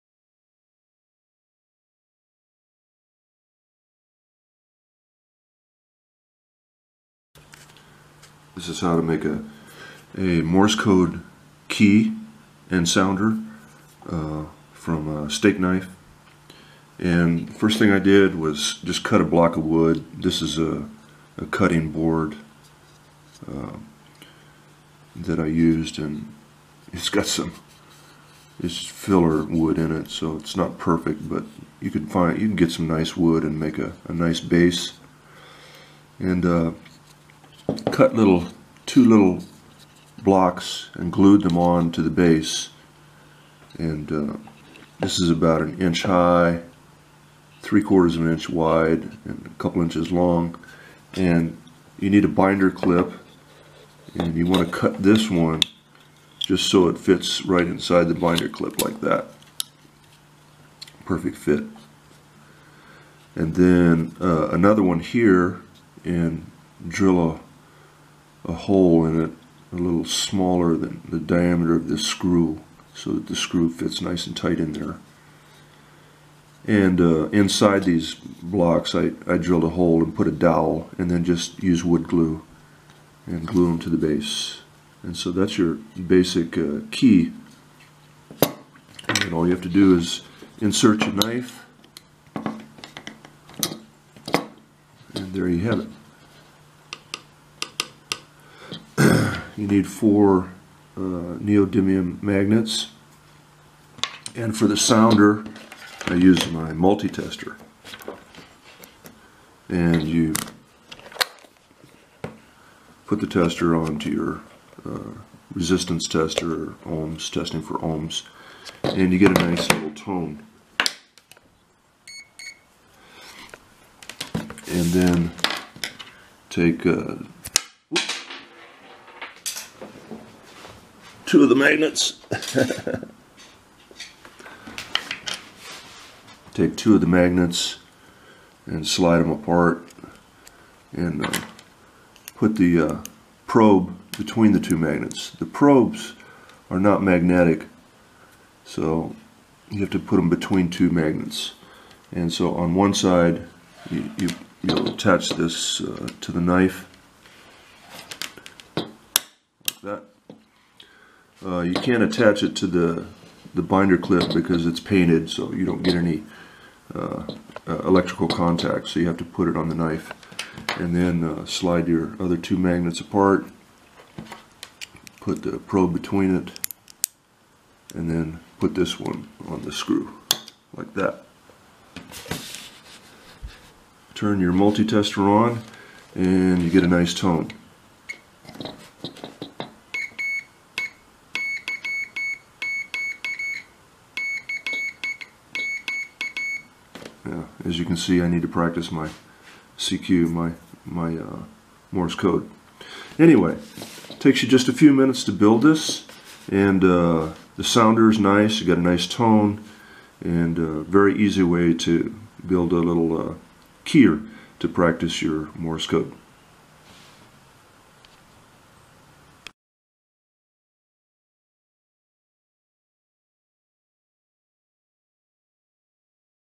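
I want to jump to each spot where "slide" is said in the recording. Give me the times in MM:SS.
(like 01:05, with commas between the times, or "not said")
02:18, 02:51.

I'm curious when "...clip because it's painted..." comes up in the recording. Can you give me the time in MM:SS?
02:43.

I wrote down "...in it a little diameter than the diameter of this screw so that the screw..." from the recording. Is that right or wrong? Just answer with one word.
wrong.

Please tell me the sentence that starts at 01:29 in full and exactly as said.
And all you have to do is insert your knife and there you have it.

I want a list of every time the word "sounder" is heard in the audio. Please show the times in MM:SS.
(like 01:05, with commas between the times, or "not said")
00:12, 01:44, 03:27.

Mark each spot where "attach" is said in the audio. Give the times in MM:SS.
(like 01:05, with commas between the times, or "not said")
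02:34, 02:42.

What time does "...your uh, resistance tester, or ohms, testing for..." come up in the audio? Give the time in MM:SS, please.
01:54.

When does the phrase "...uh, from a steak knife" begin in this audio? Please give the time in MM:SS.
00:14.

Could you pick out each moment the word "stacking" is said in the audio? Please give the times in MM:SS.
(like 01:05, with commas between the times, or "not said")
not said.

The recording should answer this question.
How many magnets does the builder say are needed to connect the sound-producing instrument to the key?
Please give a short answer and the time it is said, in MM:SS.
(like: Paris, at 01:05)
4, at 01:39.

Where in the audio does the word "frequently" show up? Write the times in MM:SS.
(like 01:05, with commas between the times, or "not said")
not said.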